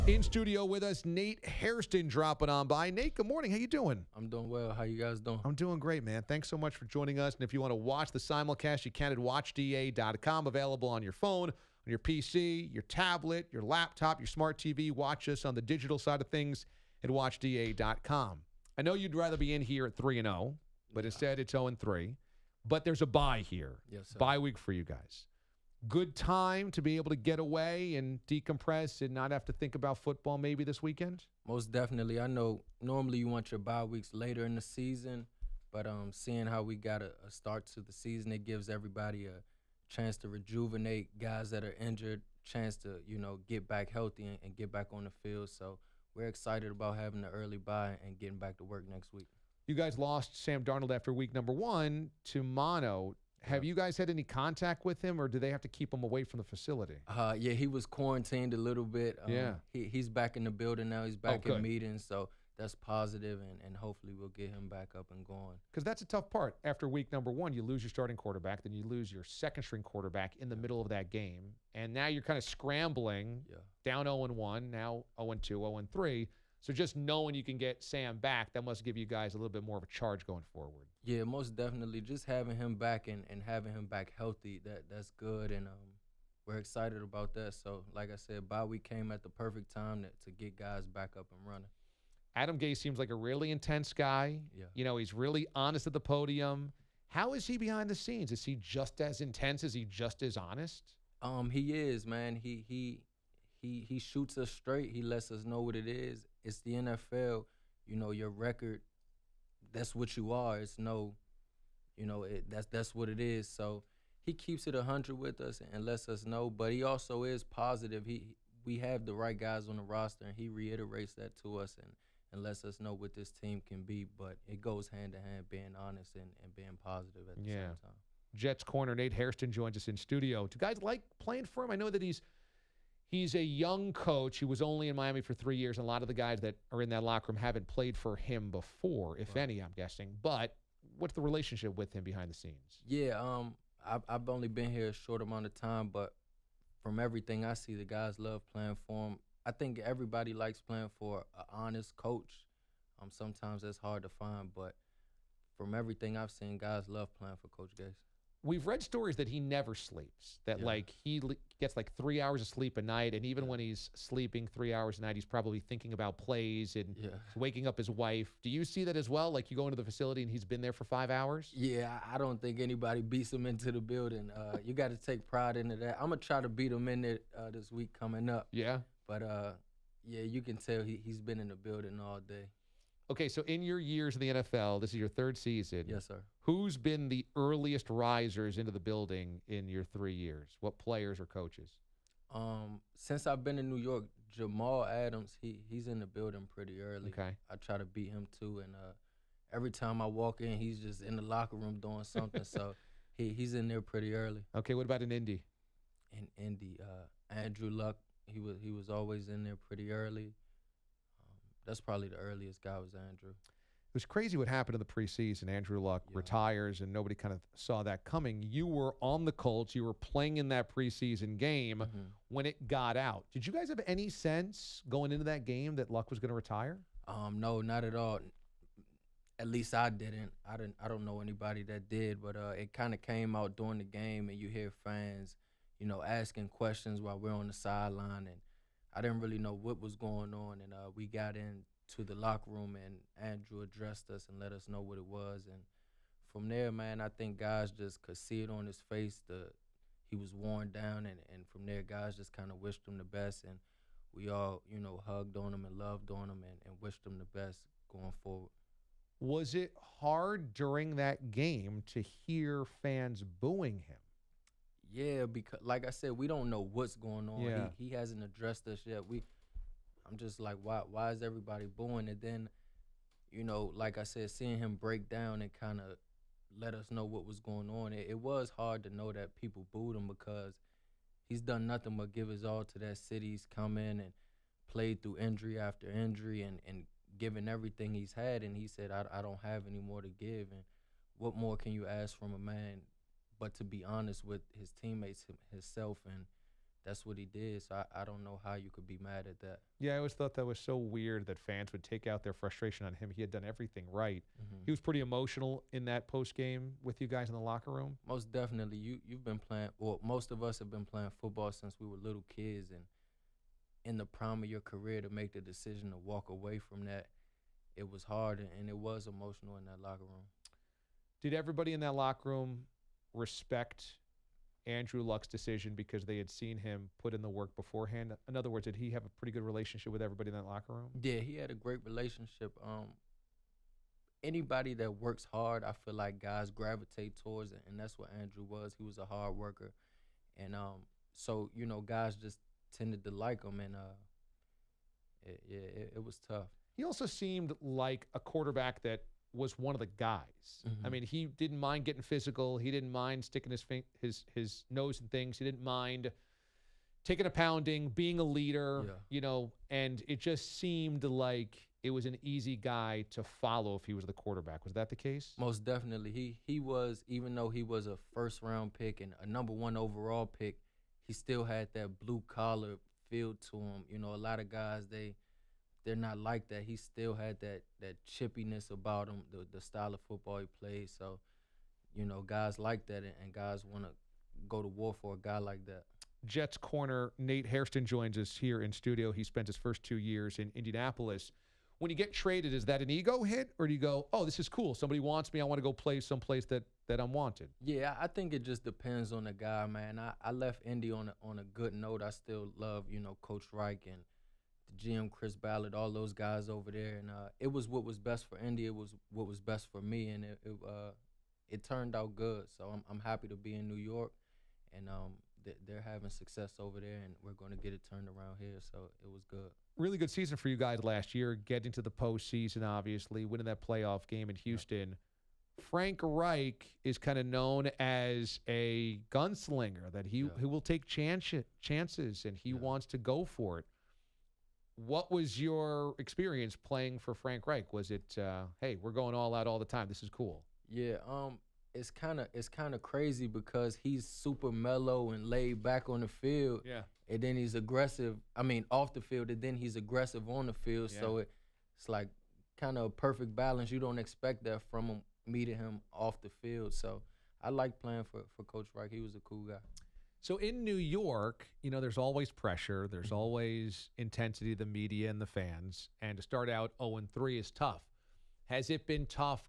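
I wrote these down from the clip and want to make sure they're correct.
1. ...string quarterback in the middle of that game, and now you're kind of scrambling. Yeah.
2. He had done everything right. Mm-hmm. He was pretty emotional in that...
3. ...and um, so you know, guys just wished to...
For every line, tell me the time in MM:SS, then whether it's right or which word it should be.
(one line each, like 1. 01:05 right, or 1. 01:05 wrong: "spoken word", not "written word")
1. 01:09 right
2. 05:03 right
3. 05:40 wrong: "tended", not "wished".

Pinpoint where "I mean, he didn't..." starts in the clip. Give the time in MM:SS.
05:50.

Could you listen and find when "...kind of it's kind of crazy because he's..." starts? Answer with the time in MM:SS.
07:21.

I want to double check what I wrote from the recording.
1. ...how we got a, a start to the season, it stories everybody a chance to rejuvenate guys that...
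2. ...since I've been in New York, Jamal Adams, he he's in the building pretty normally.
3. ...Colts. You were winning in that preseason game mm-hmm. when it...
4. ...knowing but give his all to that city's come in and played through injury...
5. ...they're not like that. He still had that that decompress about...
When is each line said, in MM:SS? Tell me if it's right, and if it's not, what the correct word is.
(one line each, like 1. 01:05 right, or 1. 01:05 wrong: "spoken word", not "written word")
1. 00:36 wrong: "gives", not "stories"
2. 03:12 wrong: "early", not "normally"
3. 03:39 wrong: "playing", not "winning"
4. 04:41 wrong: "nothing", not "knowing"
5. 06:15 wrong: "chippiness", not "decompress".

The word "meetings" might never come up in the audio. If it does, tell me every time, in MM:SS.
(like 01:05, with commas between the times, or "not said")
01:01, 07:35.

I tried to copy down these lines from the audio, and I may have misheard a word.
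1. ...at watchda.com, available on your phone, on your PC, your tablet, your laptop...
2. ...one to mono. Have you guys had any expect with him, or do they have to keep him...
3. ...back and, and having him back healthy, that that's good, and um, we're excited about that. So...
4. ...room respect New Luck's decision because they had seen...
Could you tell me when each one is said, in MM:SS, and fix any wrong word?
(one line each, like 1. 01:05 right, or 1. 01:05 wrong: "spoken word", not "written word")
1. 00:09 right
2. 00:51 wrong: "contact", not "expect"
3. 01:22 right
4. 05:22 wrong: "Andrew", not "New".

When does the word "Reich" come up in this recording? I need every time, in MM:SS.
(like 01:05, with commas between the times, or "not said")
06:43, 07:06, 07:17, 07:38.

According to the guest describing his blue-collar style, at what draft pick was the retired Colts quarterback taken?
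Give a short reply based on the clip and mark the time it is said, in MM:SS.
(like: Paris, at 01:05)
Number 1 overall, at 06:09.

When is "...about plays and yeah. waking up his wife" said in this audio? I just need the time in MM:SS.
02:45.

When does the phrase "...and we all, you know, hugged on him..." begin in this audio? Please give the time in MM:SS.
04:13.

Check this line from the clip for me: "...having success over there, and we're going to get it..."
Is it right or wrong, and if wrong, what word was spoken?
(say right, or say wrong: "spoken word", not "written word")
right.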